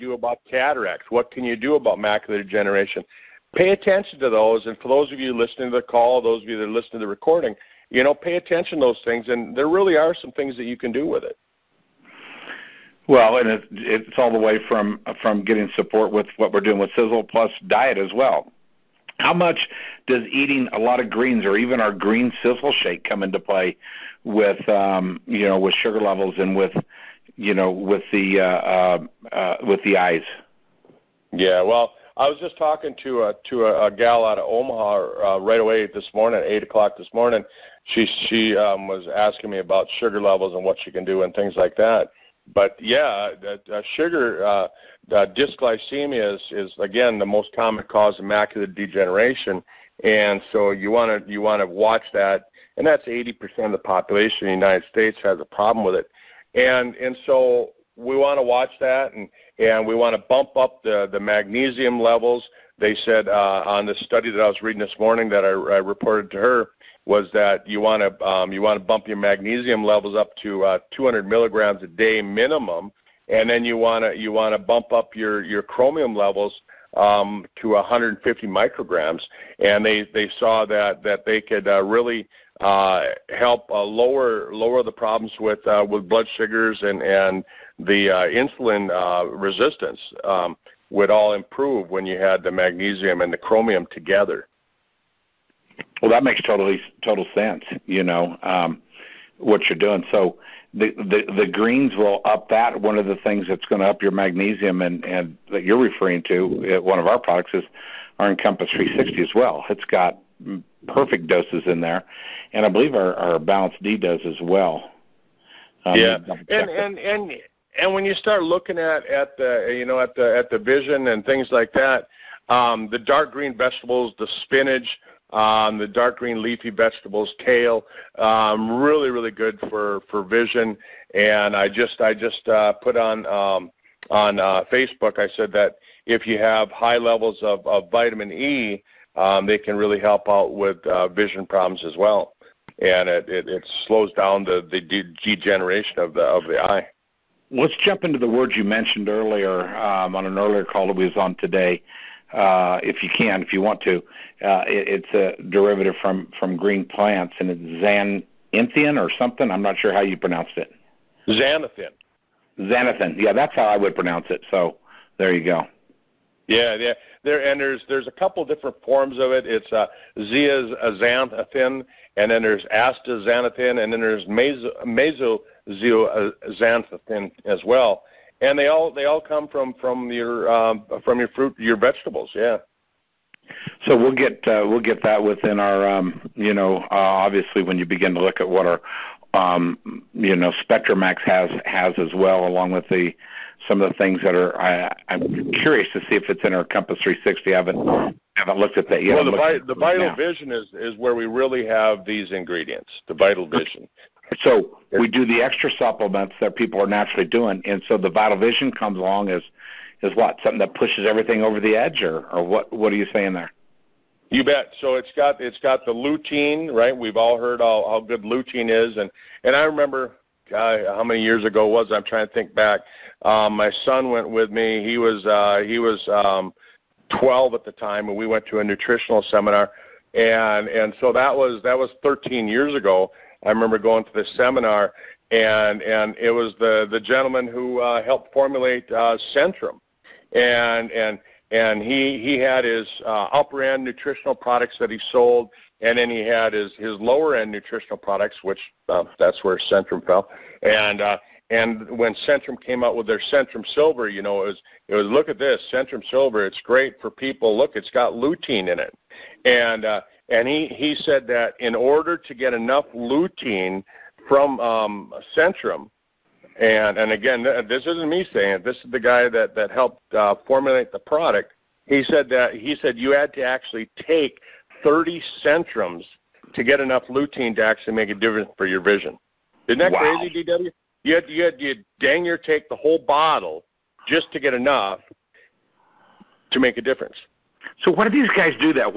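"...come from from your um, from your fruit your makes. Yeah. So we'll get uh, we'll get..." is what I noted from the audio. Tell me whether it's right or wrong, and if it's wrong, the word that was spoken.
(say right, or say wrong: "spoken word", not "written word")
wrong: "vegetables", not "makes".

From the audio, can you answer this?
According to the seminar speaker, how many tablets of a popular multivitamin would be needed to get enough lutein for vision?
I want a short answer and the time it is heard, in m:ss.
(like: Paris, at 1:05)
30, at 4:34.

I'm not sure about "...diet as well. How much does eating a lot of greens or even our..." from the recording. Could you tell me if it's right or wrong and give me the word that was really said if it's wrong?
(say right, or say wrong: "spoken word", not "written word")
right.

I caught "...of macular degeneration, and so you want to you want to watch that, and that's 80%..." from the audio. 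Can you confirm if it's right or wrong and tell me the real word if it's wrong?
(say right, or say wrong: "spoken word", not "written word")
right.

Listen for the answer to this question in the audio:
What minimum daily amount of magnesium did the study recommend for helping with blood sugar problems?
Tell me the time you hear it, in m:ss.
1:10.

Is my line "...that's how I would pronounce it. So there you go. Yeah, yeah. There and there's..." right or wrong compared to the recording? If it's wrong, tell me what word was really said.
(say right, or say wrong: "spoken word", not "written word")
right.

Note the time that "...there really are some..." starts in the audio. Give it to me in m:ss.
0:09.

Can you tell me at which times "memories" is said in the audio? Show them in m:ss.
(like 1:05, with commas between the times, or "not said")
not said.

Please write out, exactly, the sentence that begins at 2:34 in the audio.
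Uh, it, it's a derivative from, from green plants, and it's xanthine or something.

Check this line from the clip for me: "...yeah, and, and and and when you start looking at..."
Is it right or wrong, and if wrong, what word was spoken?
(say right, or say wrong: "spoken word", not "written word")
right.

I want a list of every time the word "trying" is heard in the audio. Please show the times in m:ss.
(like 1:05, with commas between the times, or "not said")
3:42.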